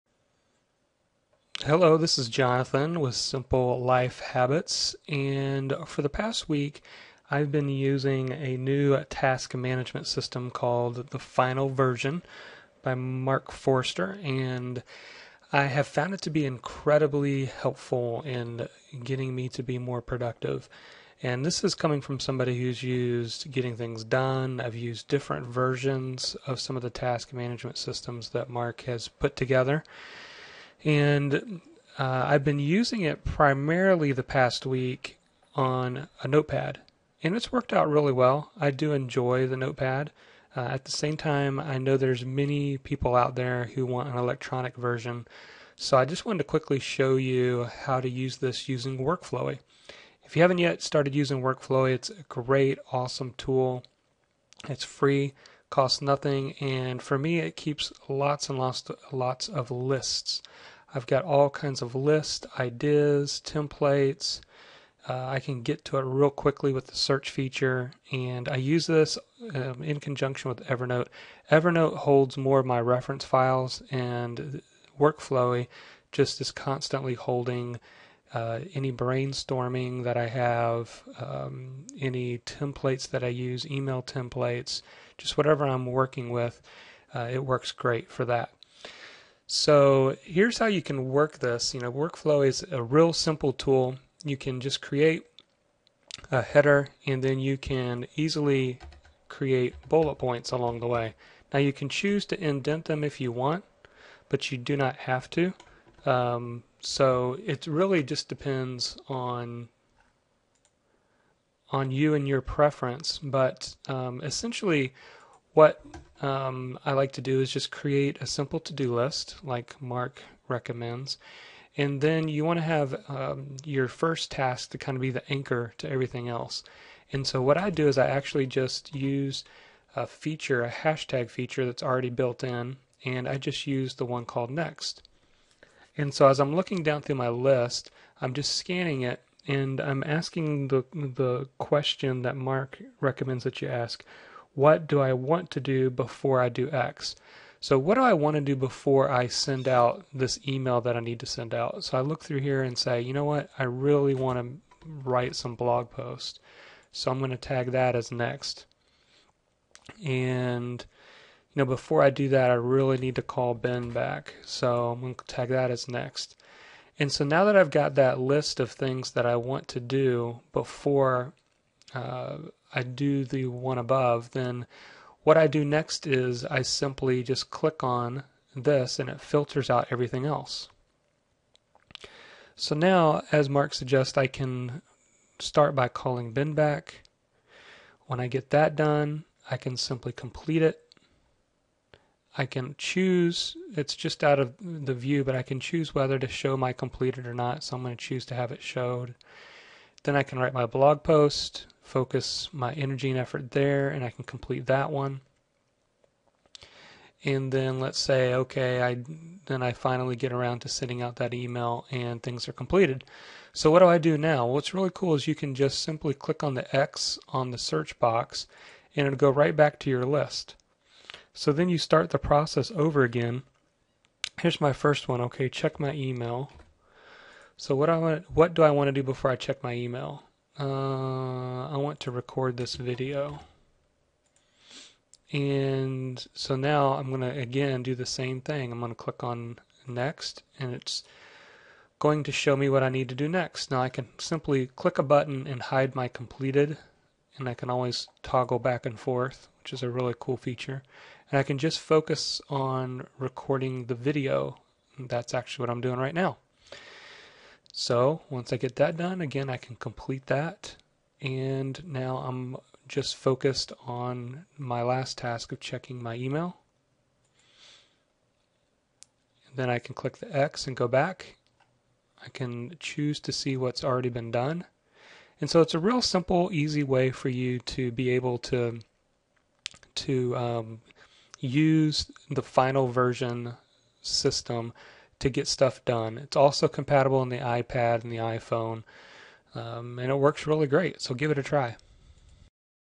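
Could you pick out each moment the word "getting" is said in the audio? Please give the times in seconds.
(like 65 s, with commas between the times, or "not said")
19 s, 23 s.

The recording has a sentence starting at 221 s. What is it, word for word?
So then you start the process over again.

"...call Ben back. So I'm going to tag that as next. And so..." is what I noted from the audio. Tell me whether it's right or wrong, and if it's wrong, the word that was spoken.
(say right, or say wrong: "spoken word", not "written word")
right.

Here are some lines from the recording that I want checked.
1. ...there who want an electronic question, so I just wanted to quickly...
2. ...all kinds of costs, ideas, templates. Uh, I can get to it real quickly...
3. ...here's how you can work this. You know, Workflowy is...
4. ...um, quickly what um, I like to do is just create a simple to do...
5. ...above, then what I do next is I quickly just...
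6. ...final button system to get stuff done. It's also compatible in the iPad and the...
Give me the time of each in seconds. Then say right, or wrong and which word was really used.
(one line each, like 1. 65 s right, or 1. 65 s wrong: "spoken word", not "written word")
1. 43 s wrong: "version", not "question"
2. 61 s wrong: "lists", not "costs"
3. 90 s right
4. 113 s wrong: "essentially", not "quickly"
5. 173 s wrong: "simply", not "quickly"
6. 282 s wrong: "version", not "button".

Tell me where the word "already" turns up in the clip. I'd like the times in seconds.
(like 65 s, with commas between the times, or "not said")
131 s, 273 s.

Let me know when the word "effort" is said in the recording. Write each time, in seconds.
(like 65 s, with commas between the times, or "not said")
203 s.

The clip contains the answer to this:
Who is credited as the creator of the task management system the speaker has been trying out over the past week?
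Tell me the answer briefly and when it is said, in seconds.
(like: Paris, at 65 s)
Mark Forster, at 12 s.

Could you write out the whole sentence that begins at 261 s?
And now I'm just focused on my last task of checking my email.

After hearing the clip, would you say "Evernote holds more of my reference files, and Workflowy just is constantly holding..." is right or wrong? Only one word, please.
right.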